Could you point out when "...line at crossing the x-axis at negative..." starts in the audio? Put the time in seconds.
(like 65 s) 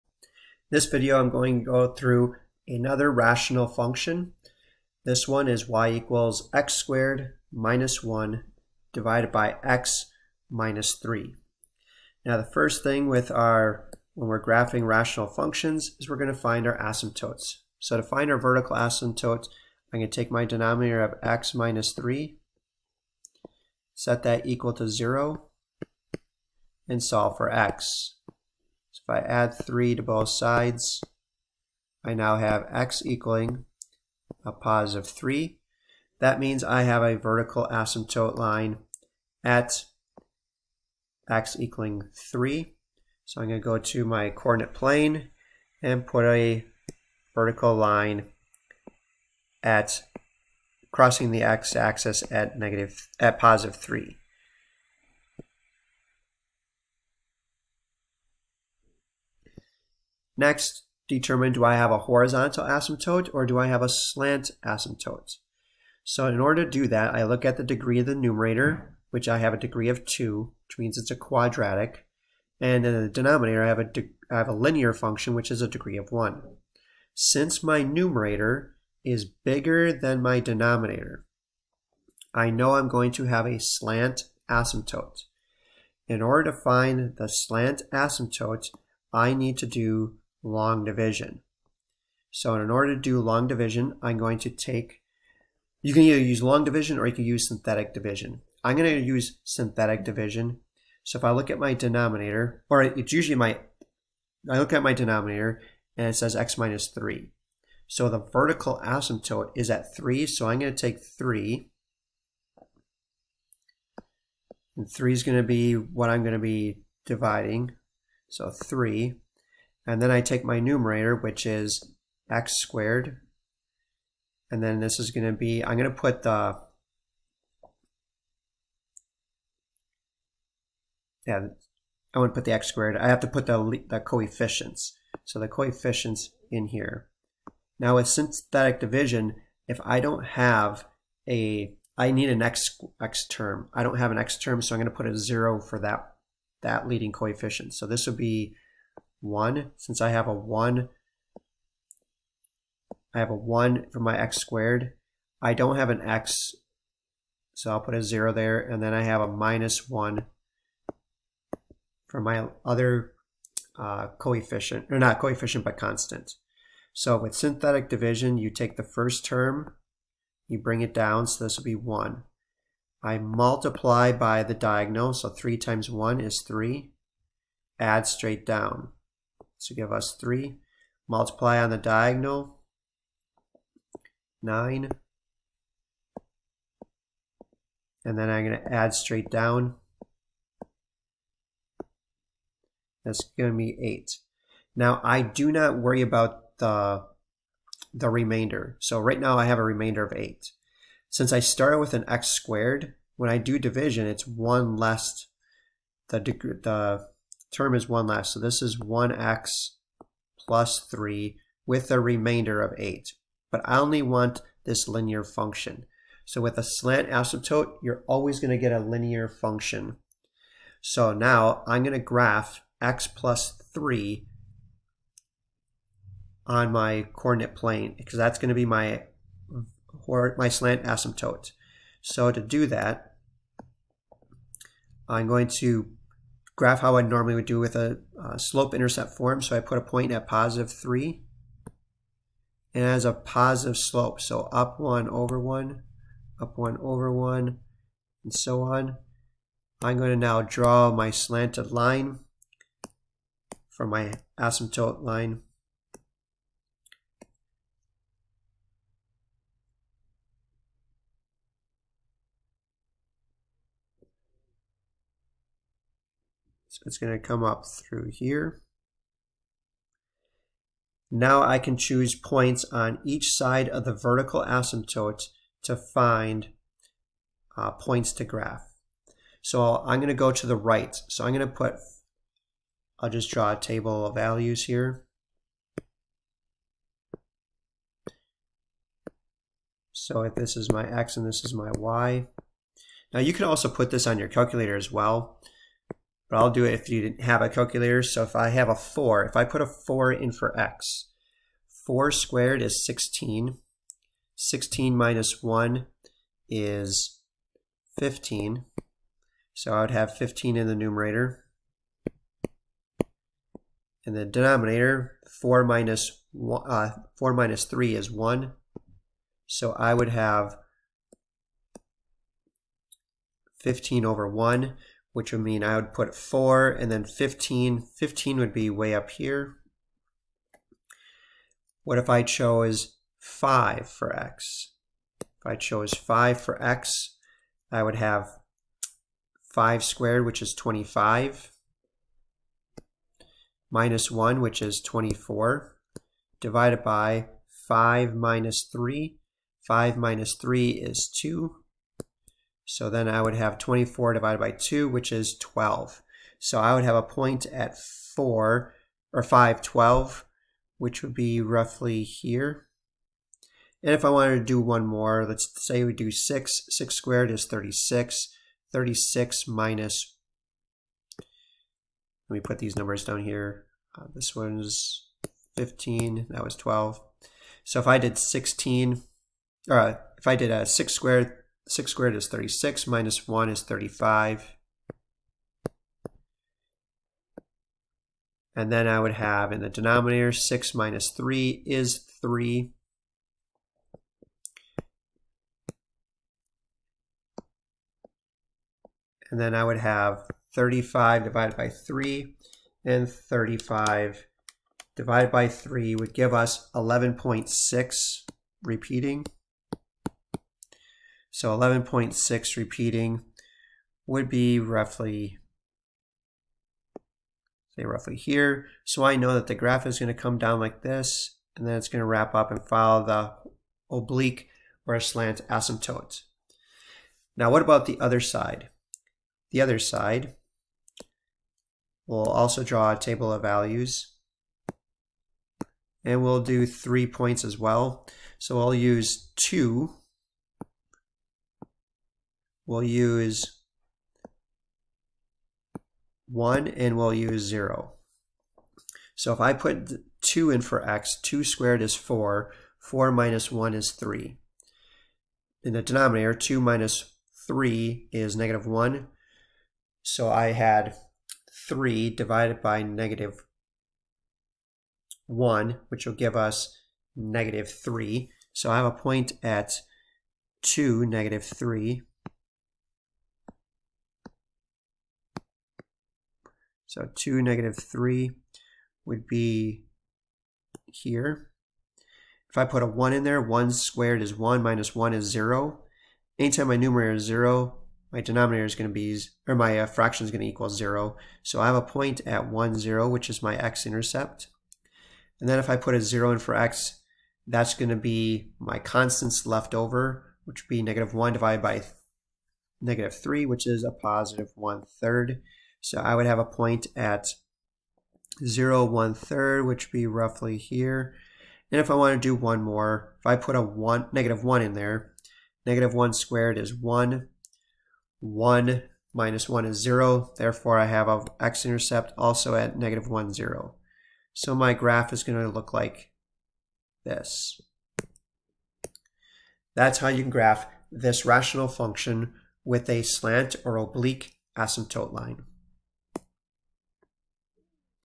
47 s.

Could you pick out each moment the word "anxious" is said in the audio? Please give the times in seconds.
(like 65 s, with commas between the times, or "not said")
not said.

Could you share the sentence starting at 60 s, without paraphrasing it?
Next, determine do I have a horizontal asymptote or do I have a slant asymptote?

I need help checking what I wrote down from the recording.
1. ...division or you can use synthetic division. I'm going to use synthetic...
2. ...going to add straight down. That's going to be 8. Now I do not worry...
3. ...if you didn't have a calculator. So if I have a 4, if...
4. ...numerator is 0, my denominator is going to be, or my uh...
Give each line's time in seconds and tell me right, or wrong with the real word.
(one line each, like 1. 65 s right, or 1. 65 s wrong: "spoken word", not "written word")
1. 96 s right
2. 188 s right
3. 296 s right
4. 486 s right.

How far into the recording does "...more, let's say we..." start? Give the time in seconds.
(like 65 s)
364 s.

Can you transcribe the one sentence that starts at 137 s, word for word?
Now with synthetic division, if I don't have a, I need an x, x term.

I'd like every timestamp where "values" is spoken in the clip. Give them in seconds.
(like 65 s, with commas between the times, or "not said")
284 s, 433 s.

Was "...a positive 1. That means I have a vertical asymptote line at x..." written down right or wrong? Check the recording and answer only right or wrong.
wrong.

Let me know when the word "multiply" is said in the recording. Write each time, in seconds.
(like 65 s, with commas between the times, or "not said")
173 s, 181 s.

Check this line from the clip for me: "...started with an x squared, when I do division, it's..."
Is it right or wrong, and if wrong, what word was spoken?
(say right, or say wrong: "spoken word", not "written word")
right.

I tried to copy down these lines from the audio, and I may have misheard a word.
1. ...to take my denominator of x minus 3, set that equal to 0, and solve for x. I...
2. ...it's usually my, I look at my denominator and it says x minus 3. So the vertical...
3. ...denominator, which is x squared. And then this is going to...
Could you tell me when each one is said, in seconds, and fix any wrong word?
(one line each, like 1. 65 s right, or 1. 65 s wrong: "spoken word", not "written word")
1. 20 s right
2. 102 s right
3. 120 s wrong: "numerator", not "denominator".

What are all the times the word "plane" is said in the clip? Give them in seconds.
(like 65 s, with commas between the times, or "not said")
44 s, 227 s.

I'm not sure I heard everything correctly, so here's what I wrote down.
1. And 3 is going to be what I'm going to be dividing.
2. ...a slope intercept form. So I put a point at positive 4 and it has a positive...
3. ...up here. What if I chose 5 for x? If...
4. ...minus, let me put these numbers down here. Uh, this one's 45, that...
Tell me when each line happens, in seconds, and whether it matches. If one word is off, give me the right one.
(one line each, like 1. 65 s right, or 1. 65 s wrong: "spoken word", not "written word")
1. 114 s right
2. 238 s wrong: "3", not "4"
3. 328 s right
4. 369 s wrong: "15", not "45".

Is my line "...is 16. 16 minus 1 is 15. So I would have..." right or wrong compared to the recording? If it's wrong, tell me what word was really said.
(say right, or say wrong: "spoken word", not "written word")
right.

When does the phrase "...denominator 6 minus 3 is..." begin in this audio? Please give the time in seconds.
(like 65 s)
389 s.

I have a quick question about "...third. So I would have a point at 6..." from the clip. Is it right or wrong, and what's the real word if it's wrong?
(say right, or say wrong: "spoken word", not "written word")
wrong: "0", not "6".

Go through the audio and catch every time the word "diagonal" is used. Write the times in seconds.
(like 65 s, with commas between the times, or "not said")
174 s, 181 s.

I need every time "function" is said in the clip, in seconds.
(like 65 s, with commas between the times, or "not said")
3 s, 15 s, 74 s, 215 s, 219 s, 531 s.